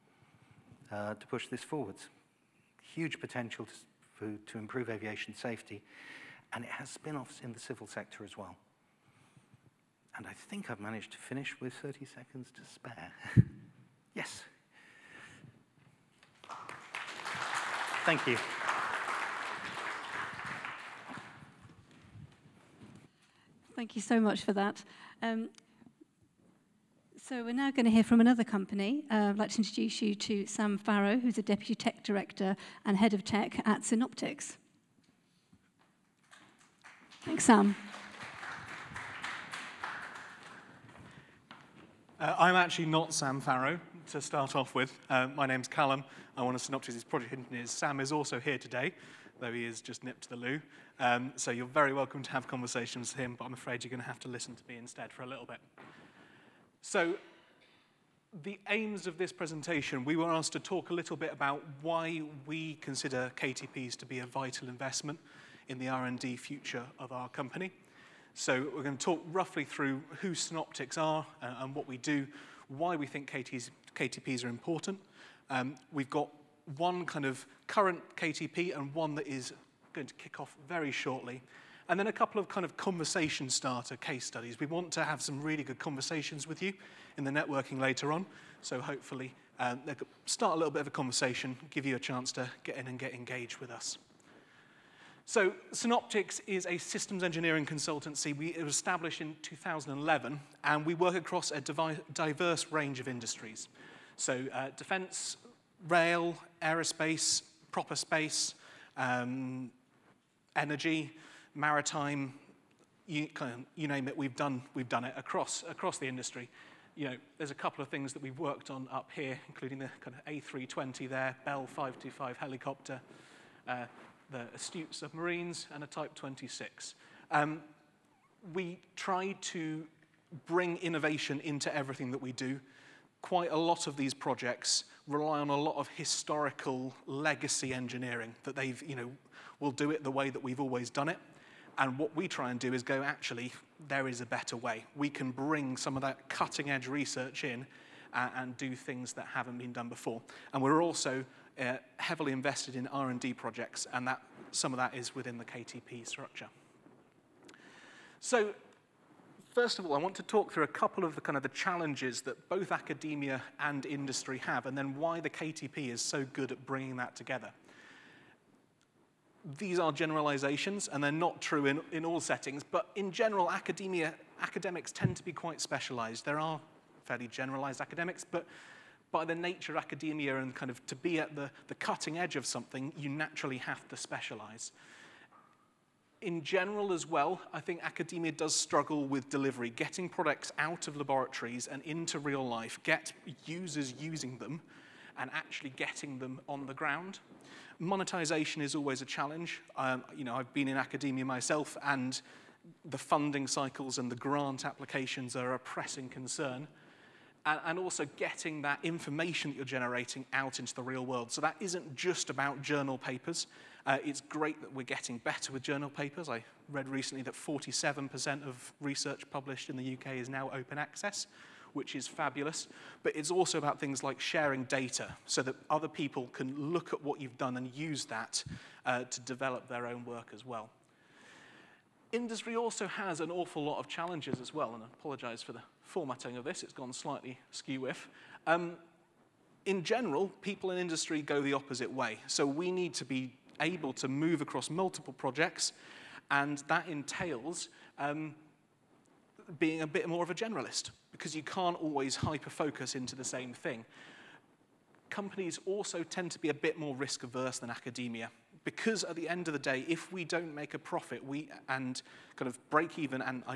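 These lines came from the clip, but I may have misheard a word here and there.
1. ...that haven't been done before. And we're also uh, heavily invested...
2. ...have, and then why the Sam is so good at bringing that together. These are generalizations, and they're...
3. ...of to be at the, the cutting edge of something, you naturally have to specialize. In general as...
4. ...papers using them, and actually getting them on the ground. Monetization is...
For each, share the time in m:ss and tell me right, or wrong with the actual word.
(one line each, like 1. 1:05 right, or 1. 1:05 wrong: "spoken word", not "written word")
1. 2:29 right
2. 2:44 wrong: "KTP", not "Sam"
3. 3:00 right
4. 3:13 wrong: "users", not "papers".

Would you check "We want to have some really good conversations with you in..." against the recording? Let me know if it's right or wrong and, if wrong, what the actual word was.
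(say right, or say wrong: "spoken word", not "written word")
right.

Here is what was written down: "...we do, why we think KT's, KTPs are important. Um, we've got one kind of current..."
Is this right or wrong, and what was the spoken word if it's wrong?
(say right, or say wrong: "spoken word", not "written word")
right.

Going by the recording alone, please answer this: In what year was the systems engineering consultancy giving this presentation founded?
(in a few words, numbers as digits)
2011.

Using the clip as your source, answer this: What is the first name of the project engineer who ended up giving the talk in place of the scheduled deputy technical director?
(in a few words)
Callum.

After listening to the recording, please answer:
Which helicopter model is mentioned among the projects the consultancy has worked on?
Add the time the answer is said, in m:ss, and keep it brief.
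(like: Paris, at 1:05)
Bell 525, at 2:01.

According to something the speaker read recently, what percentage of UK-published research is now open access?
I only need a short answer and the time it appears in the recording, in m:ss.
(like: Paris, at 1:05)
47%, at 3:37.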